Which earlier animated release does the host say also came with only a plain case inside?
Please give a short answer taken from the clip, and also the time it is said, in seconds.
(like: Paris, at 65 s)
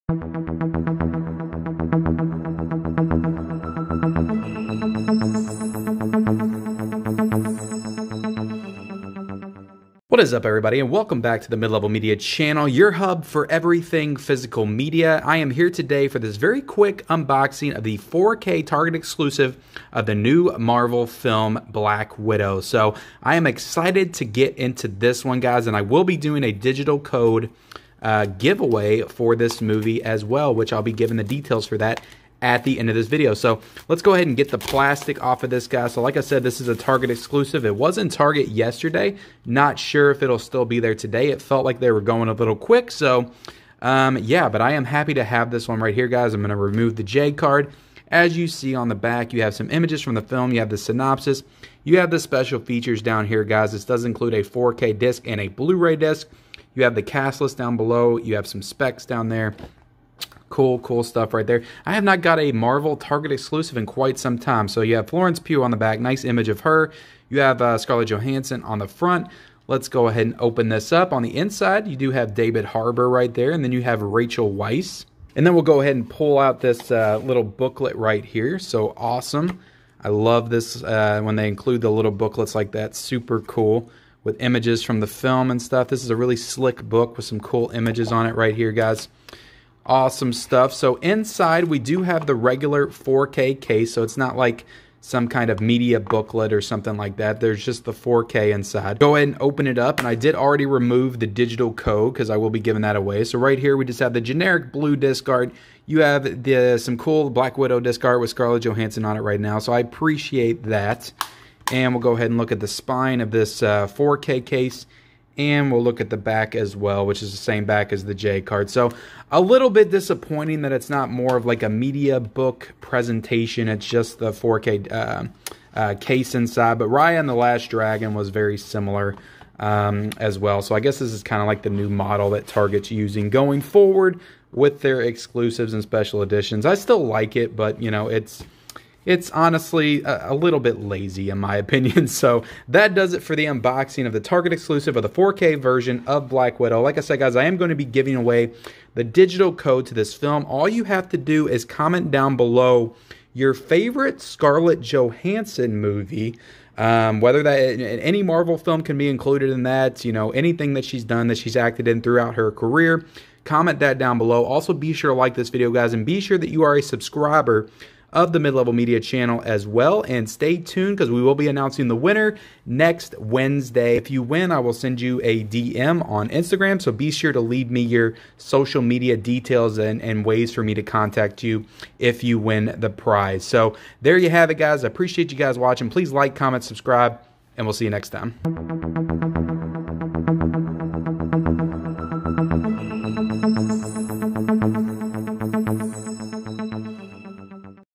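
Raya and the Last Dragon, at 126 s.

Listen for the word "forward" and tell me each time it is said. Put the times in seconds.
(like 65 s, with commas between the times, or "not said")
133 s.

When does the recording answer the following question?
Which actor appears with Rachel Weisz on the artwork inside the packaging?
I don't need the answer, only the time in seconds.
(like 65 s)
72 s.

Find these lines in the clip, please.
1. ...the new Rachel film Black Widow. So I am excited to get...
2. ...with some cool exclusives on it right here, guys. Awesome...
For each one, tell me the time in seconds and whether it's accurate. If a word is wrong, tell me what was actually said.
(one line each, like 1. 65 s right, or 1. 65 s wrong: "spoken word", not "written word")
1. 20 s wrong: "Marvel", not "Rachel"
2. 87 s wrong: "images", not "exclusives".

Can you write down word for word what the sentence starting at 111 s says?
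And we'll go ahead and look at the spine of this uh, 4K case.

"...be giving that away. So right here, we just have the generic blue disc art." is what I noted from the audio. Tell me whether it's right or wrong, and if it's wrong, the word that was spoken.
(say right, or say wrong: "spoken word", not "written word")
right.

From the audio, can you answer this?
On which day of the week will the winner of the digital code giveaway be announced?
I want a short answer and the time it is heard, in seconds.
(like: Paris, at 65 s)
Wednesday, at 173 s.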